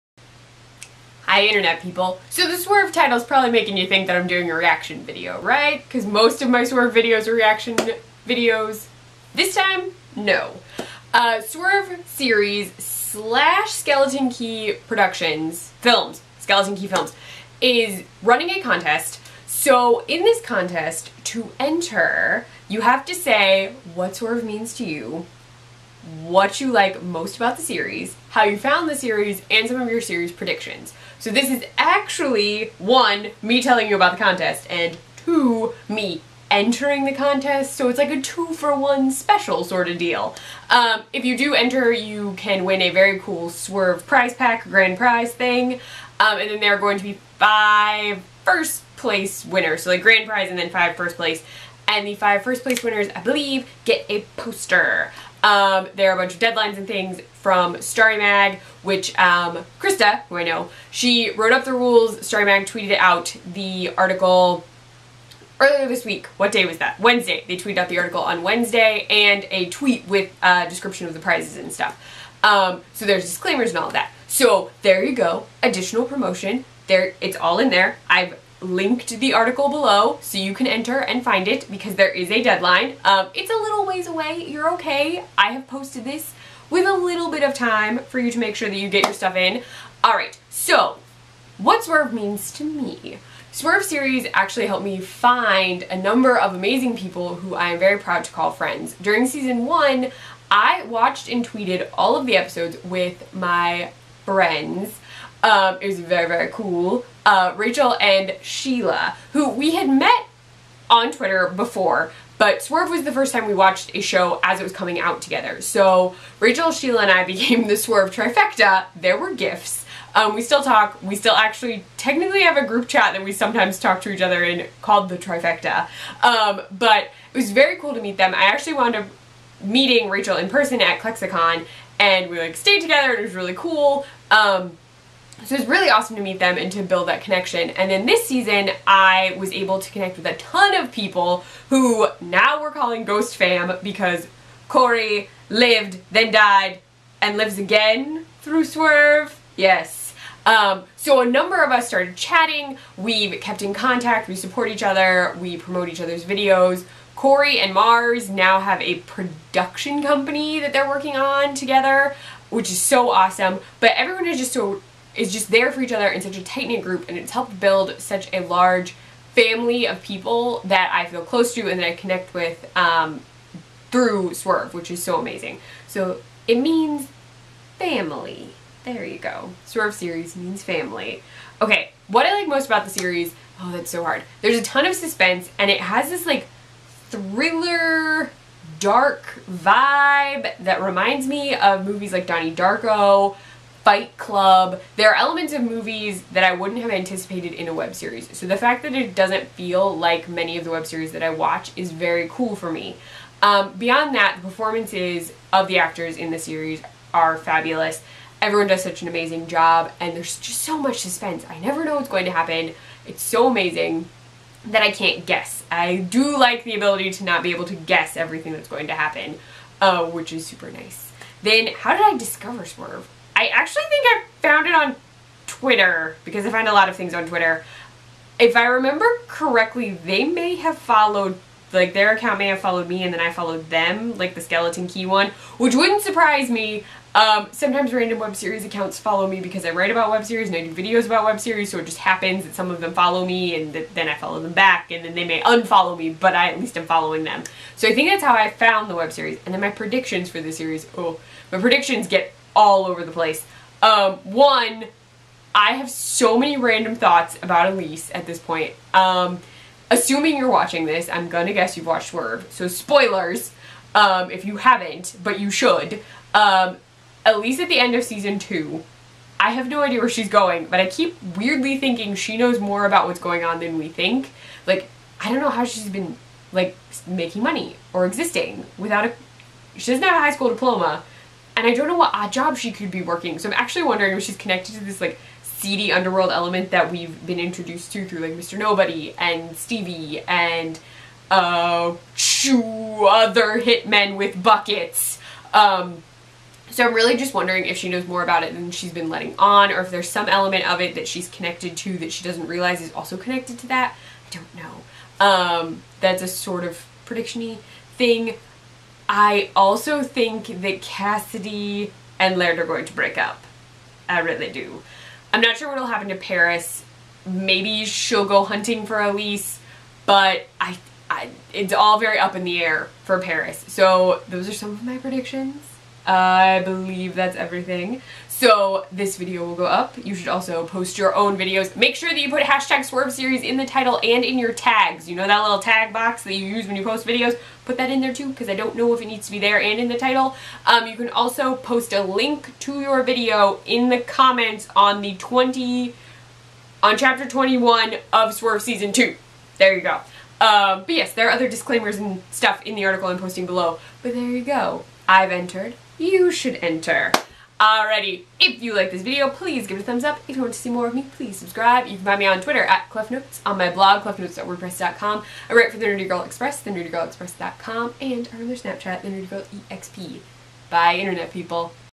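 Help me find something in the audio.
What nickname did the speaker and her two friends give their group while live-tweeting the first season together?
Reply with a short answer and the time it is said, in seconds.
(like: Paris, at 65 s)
the Swerve trifecta, at 117 s.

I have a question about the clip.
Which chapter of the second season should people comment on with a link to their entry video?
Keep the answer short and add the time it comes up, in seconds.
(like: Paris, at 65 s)
Chapter 21, at 346 s.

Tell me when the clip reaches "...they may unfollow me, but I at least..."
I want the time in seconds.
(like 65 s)
245 s.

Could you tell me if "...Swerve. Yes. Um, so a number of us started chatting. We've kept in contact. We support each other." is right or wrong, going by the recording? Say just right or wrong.
right.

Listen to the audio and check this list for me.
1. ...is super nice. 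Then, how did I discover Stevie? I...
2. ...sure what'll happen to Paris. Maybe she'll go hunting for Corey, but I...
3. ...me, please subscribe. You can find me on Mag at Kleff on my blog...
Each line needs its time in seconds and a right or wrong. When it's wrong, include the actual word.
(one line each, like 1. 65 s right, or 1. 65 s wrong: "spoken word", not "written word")
1. 220 s wrong: "Swerve", not "Stevie"
2. 315 s wrong: "Elise", not "Corey"
3. 360 s wrong: "Twitter", not "Mag".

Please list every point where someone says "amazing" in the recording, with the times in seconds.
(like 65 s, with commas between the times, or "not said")
96 s, 175 s, 209 s, 213 s.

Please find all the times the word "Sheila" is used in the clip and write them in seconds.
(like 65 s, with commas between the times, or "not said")
108 s, 116 s.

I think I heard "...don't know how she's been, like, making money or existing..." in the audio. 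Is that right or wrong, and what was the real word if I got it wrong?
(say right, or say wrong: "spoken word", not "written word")
right.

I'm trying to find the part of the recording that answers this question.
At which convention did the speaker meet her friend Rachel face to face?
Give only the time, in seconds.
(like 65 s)
130 s.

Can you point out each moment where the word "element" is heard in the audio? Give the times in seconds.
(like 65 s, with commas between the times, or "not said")
195 s, 286 s, 300 s.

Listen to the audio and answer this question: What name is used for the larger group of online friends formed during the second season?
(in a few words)
Ghost Fam.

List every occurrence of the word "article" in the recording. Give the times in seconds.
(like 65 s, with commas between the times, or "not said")
63 s, 67 s, 79 s, 352 s.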